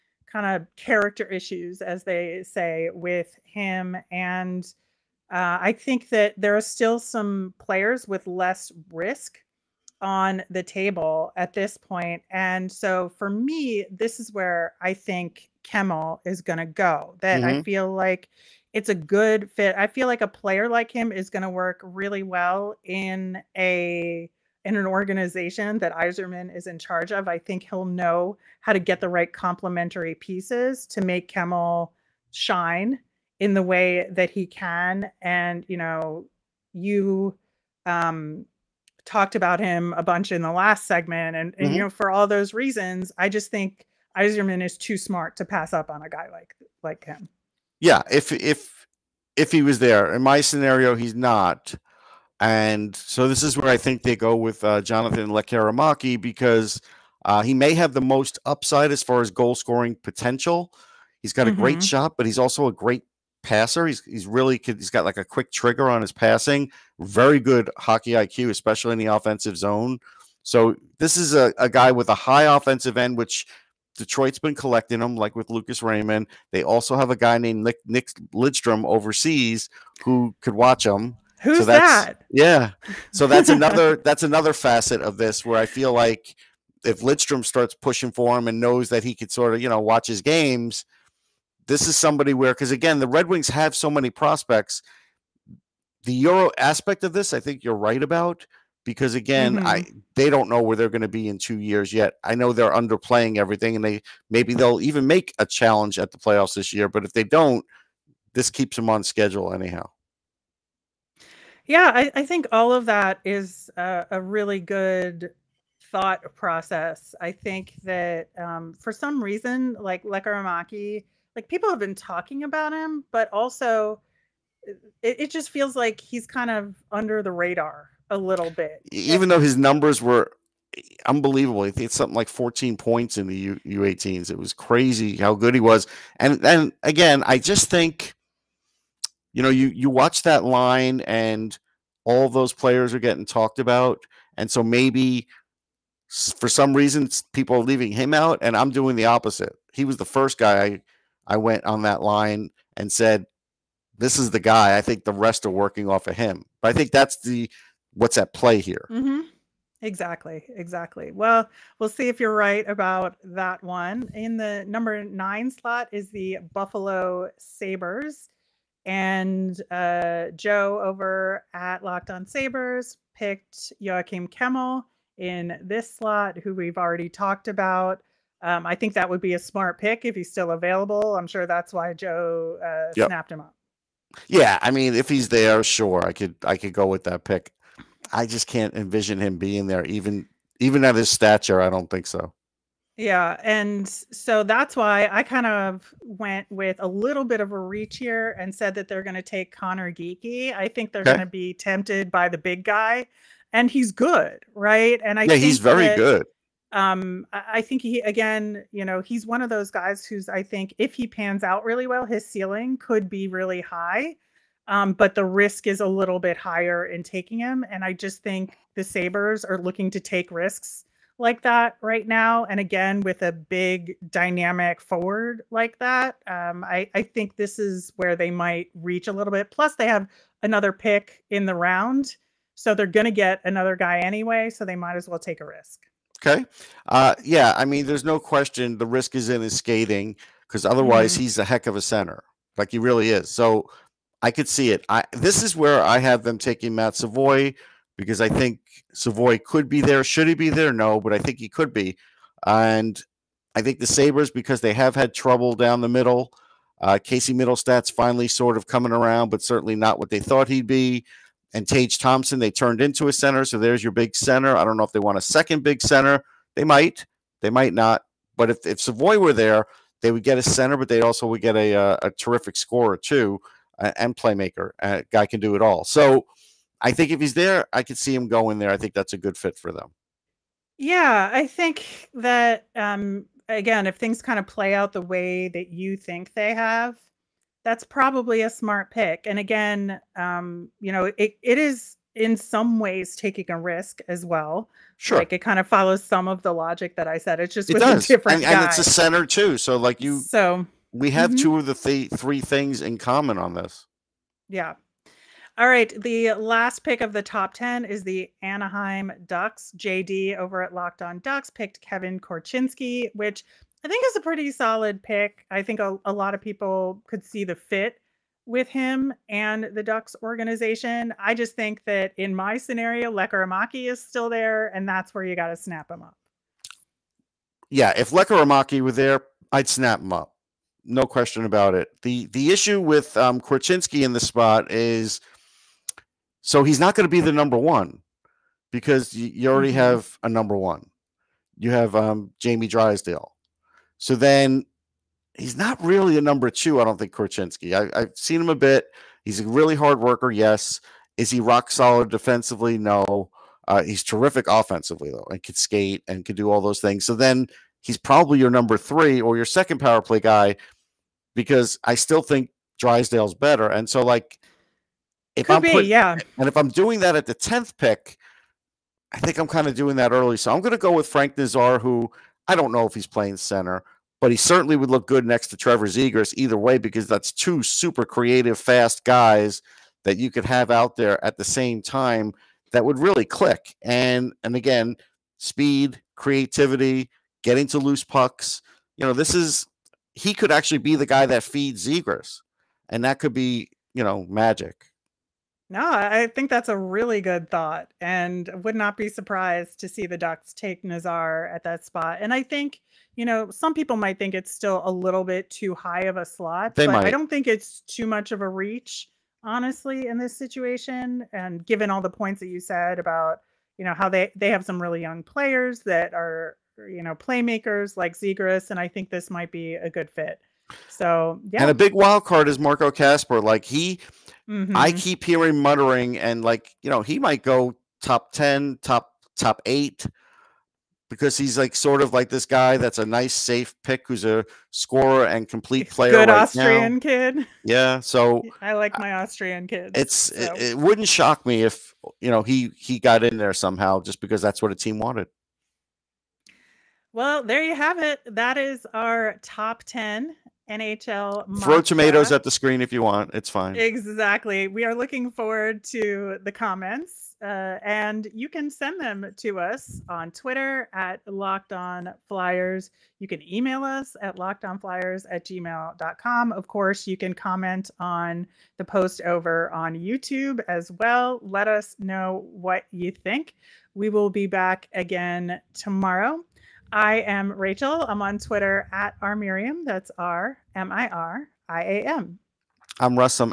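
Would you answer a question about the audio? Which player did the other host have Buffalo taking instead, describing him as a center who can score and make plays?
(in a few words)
Matt Savoy.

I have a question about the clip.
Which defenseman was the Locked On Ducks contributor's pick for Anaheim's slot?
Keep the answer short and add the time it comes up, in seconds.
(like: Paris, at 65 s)
Kevin Korchinski, at 311 s.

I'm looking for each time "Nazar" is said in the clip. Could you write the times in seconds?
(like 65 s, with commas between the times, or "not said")
371 s, 400 s.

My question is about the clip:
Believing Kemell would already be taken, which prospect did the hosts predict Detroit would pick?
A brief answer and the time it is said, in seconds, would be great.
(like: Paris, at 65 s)
Jonathan Lekkerimaki, at 54 s.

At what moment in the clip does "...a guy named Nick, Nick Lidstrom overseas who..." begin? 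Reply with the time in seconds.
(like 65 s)
77 s.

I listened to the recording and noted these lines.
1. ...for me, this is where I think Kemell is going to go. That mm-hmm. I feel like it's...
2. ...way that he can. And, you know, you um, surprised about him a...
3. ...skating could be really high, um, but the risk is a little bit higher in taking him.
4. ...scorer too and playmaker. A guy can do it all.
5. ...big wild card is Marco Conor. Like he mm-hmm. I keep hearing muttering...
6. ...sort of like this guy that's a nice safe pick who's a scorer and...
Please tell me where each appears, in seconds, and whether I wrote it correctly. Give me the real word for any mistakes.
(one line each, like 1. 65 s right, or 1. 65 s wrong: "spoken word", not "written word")
1. 13 s right
2. 33 s wrong: "talked", not "surprised"
3. 212 s wrong: "ceiling", not "skating"
4. 272 s right
5. 421 s wrong: "Kasper", not "Conor"
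6. 431 s right.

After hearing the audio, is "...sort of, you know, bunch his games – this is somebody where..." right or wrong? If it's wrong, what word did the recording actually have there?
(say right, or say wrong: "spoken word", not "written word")
wrong: "watch", not "bunch".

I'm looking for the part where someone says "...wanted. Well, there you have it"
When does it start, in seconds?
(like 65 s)
444 s.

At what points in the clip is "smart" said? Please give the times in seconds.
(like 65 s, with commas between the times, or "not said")
44 s, 179 s, 288 s.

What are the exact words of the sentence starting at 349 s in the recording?
He's a really hard worker, yes.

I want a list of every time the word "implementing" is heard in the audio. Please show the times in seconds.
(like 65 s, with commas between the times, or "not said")
not said.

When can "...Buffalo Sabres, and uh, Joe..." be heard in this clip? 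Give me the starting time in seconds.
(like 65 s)
166 s.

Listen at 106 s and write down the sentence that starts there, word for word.
But if they don't, this keeps them on schedule anyhow.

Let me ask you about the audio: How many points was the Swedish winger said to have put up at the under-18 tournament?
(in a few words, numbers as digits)
14.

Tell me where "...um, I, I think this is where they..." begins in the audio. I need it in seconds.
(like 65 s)
226 s.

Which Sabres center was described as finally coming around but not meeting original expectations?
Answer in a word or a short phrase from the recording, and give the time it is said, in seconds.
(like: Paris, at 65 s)
Casey Mittelstadt, at 257 s.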